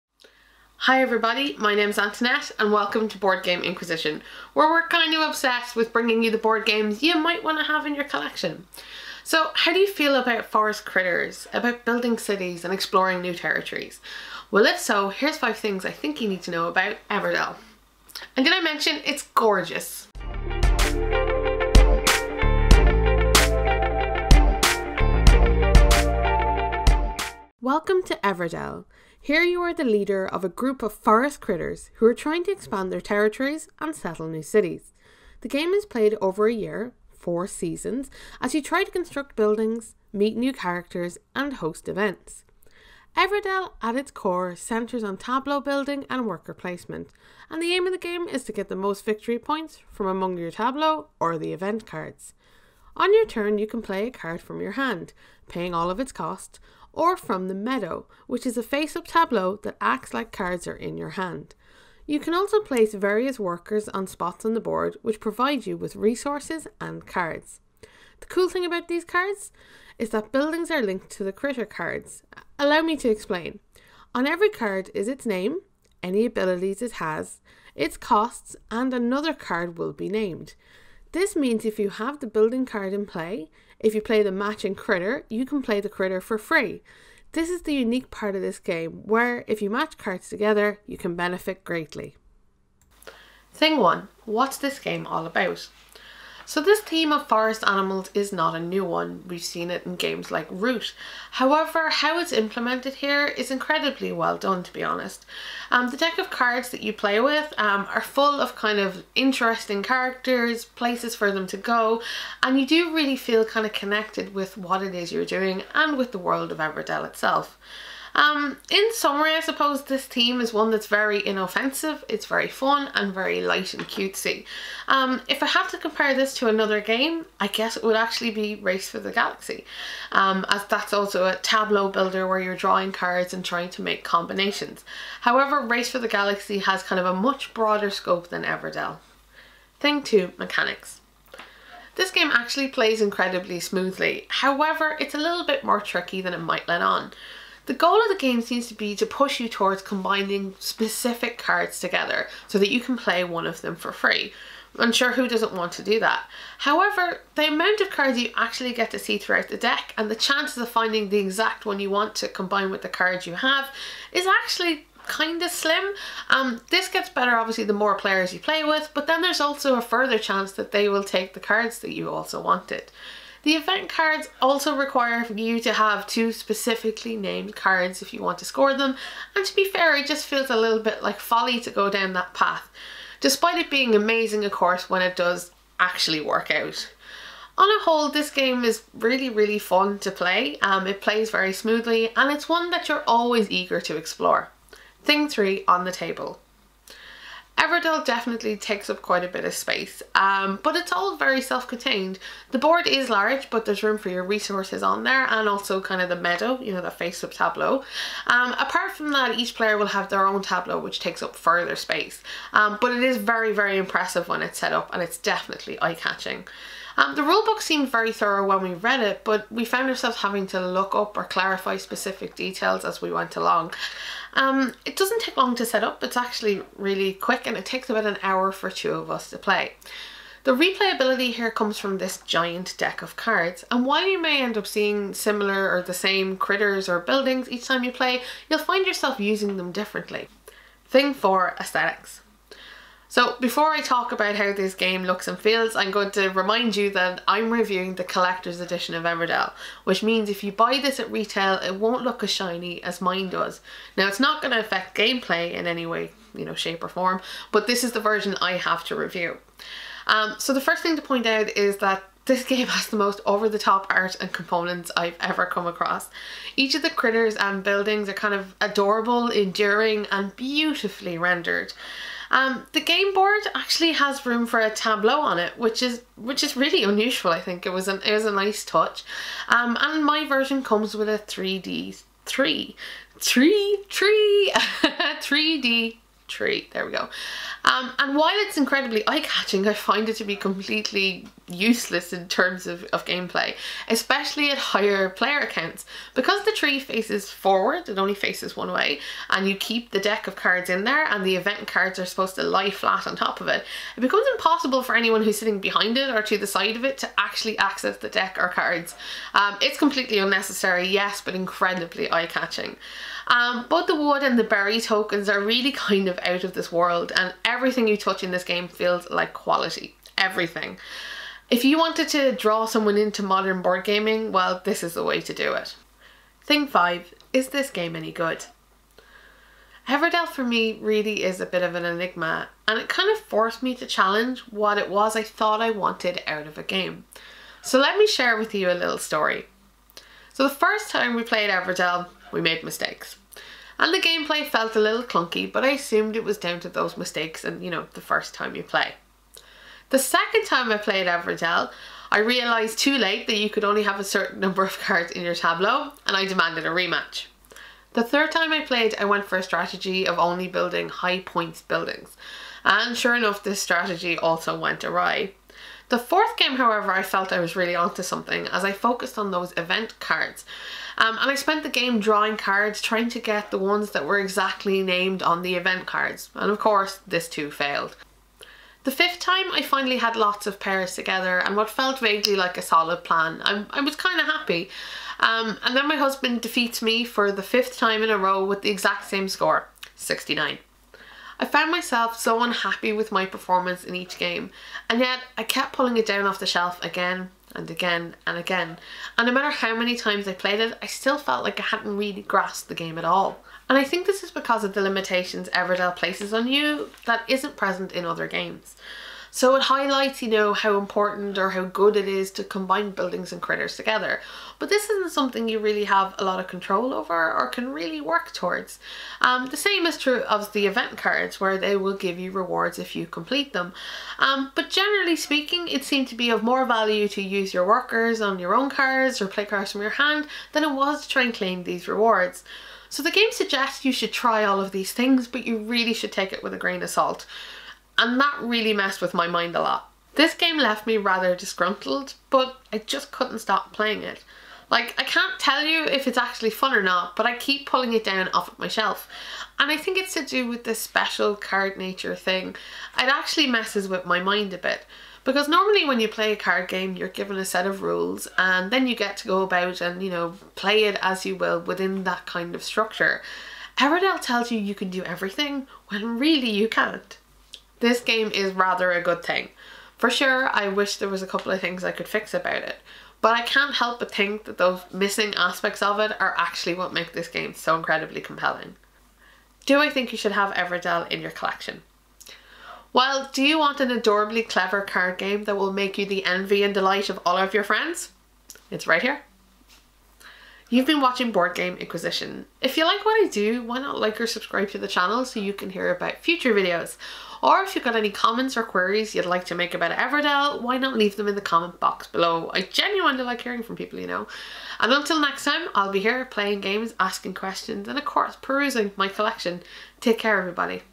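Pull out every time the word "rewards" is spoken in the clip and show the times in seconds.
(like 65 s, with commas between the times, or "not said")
422 s, 431 s.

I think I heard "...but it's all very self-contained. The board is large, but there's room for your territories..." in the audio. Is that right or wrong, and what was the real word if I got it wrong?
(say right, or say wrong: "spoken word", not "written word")
wrong: "resources", not "territories".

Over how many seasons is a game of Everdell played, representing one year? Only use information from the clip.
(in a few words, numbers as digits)
4.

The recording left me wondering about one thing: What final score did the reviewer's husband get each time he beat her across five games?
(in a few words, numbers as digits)
69.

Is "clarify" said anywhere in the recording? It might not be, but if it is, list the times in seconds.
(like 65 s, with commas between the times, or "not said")
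221 s.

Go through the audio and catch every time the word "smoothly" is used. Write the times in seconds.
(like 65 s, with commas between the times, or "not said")
143 s, 191 s.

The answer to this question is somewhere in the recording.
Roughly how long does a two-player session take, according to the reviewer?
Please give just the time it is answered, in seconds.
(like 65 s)
227 s.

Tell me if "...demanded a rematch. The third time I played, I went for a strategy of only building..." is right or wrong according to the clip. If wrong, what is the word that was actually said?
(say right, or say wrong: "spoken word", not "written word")
right.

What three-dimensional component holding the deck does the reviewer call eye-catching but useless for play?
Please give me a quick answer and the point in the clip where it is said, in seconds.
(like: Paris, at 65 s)
3D tree, at 284 s.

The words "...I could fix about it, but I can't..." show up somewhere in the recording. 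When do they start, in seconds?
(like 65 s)
471 s.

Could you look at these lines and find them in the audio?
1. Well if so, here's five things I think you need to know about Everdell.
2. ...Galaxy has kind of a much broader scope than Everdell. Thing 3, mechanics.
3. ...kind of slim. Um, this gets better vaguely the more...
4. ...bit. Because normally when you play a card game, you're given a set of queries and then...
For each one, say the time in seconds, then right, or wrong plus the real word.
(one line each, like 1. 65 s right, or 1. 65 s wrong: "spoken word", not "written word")
1. 14 s right
2. 136 s wrong: "2", not "3"
3. 165 s wrong: "obviously", not "vaguely"
4. 454 s wrong: "rules", not "queries".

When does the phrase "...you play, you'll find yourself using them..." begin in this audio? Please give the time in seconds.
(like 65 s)
237 s.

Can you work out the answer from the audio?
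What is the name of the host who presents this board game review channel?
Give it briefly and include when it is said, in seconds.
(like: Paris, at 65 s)
Antoinette, at 1 s.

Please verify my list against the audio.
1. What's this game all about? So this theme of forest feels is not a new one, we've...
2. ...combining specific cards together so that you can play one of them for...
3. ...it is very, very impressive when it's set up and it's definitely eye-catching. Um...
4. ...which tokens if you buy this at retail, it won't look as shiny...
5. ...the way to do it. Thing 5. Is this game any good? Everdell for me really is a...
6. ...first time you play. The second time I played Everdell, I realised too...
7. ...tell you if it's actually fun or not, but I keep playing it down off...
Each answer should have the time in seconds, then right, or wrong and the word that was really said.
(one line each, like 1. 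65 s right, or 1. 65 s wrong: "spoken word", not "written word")
1. 94 s wrong: "animals", not "feels"
2. 149 s right
3. 212 s right
4. 249 s wrong: "means", not "tokens"
5. 324 s right
6. 348 s right
7. 445 s wrong: "pulling", not "playing".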